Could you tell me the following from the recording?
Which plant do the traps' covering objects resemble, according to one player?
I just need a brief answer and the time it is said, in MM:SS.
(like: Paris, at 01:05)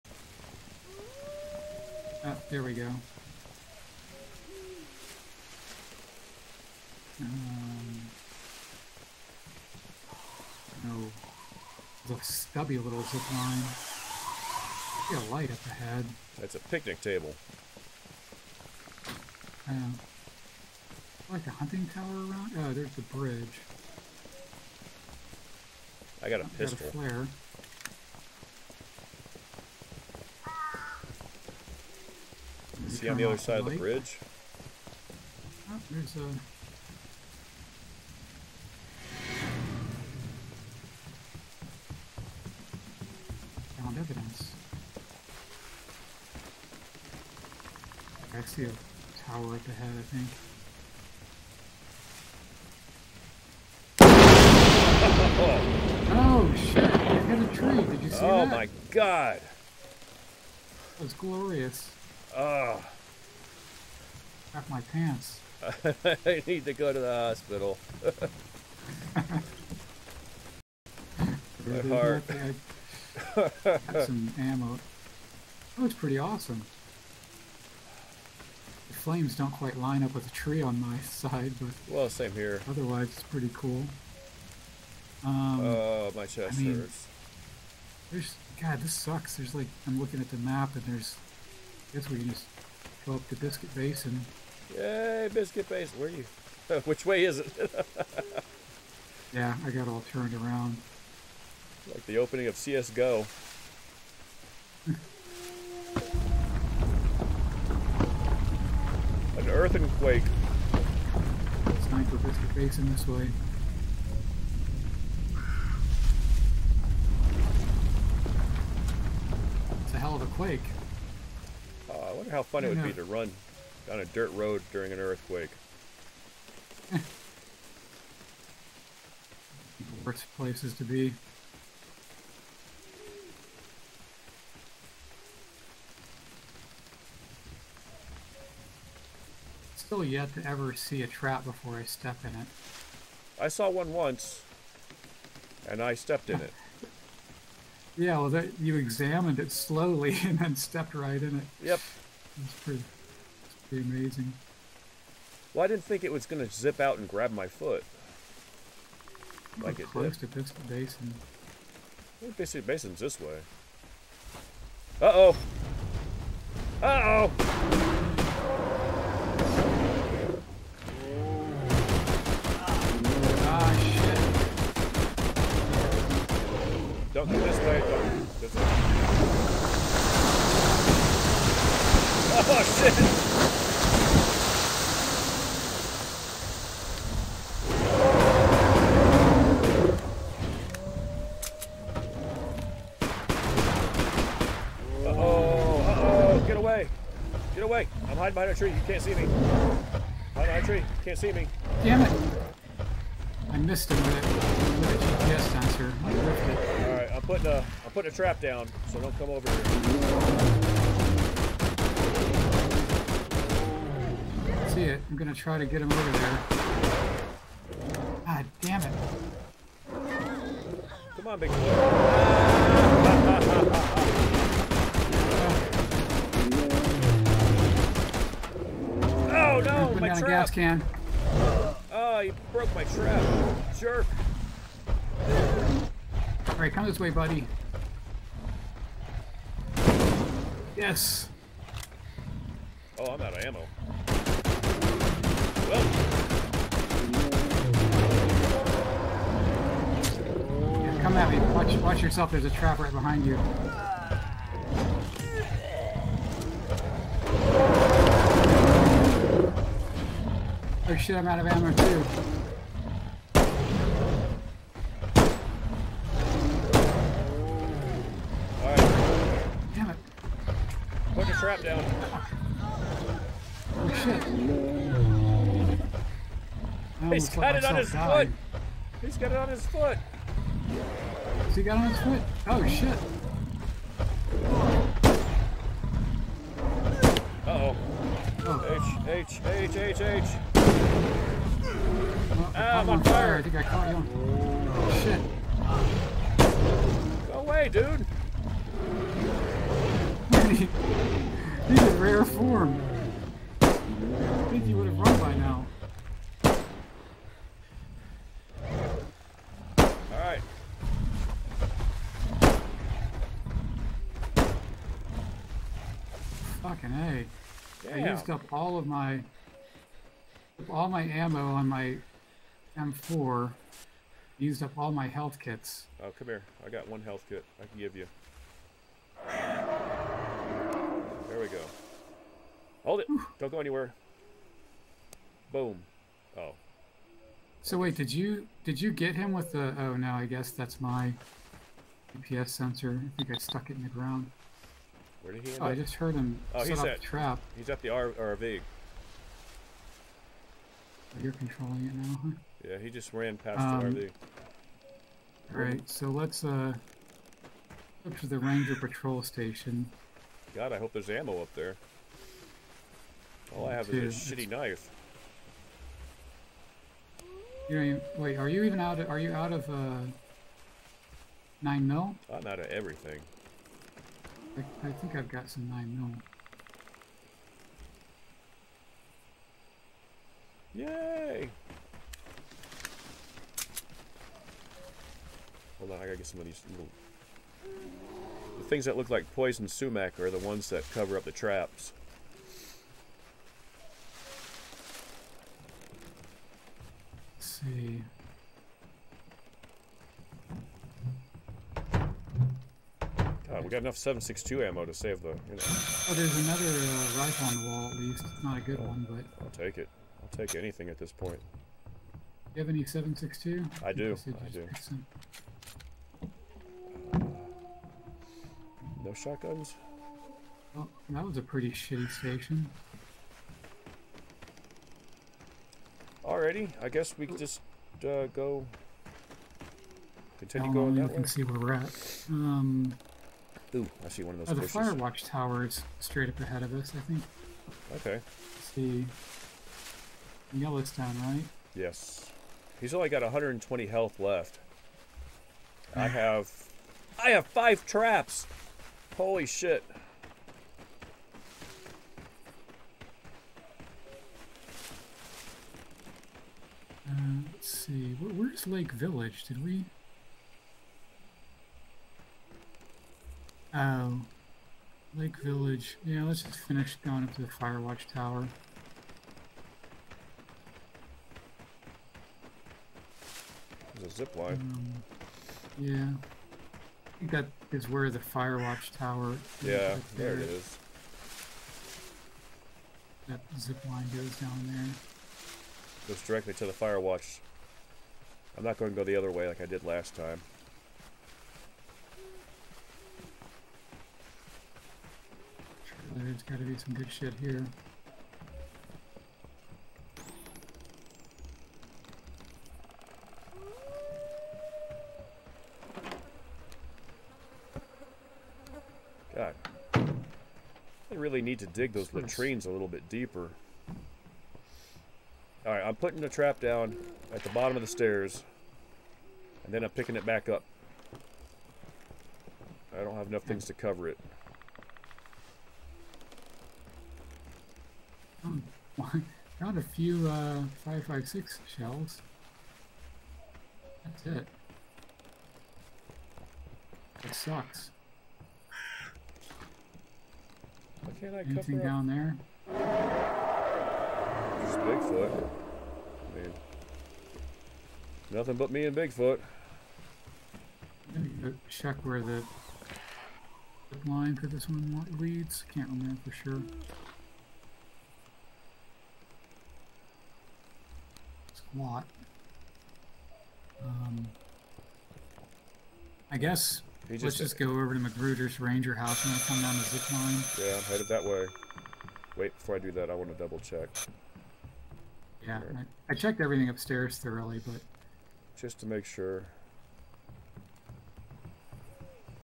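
poison sumac, at 06:29.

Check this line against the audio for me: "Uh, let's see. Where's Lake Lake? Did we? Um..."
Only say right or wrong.
wrong.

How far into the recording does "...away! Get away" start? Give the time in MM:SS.
03:16.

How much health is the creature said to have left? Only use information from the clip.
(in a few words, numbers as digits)
120.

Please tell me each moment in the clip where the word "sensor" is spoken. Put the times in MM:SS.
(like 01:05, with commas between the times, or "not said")
03:25, 05:42.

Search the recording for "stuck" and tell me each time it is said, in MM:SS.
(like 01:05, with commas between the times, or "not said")
05:43.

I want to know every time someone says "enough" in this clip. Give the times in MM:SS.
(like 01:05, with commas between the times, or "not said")
06:43, 08:43.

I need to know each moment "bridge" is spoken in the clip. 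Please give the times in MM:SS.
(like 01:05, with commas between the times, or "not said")
00:23, 00:33.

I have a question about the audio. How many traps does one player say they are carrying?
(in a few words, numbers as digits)
5.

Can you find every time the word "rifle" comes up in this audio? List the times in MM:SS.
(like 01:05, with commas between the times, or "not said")
06:47.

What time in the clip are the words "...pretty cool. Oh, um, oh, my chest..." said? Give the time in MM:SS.
01:23.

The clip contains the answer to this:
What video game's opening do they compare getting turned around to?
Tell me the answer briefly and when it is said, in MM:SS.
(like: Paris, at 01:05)
CSGO, at 01:41.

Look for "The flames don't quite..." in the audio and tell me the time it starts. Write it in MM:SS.
01:18.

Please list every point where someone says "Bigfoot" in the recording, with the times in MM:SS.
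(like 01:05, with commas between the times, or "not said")
09:02, 09:08.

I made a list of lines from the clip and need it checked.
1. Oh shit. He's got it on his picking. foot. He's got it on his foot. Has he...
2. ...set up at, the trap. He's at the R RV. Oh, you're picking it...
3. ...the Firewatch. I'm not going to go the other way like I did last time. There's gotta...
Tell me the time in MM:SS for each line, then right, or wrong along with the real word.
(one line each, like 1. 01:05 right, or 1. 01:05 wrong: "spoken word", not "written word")
1. 04:33 wrong: "dying", not "picking"
2. 05:46 wrong: "controlling", not "picking"
3. 08:06 right.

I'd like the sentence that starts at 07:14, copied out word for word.
Oh, the fire watch tower is straight up ahead of us, I think.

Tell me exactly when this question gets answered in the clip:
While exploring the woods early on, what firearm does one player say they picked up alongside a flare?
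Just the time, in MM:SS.
00:26.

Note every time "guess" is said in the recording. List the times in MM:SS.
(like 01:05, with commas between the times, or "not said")
01:31, 05:40, 07:06, 09:26.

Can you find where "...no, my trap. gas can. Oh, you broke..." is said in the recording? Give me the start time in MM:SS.
03:49.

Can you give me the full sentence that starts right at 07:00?
Well, that was a pretty shitty station.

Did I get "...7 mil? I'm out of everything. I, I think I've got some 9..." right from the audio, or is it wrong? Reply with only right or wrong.
wrong.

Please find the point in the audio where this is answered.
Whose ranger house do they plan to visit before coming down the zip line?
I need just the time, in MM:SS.
09:27.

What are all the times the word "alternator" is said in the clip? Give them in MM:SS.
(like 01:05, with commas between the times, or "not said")
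not said.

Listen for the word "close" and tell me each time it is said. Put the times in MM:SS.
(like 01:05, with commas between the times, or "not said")
02:39.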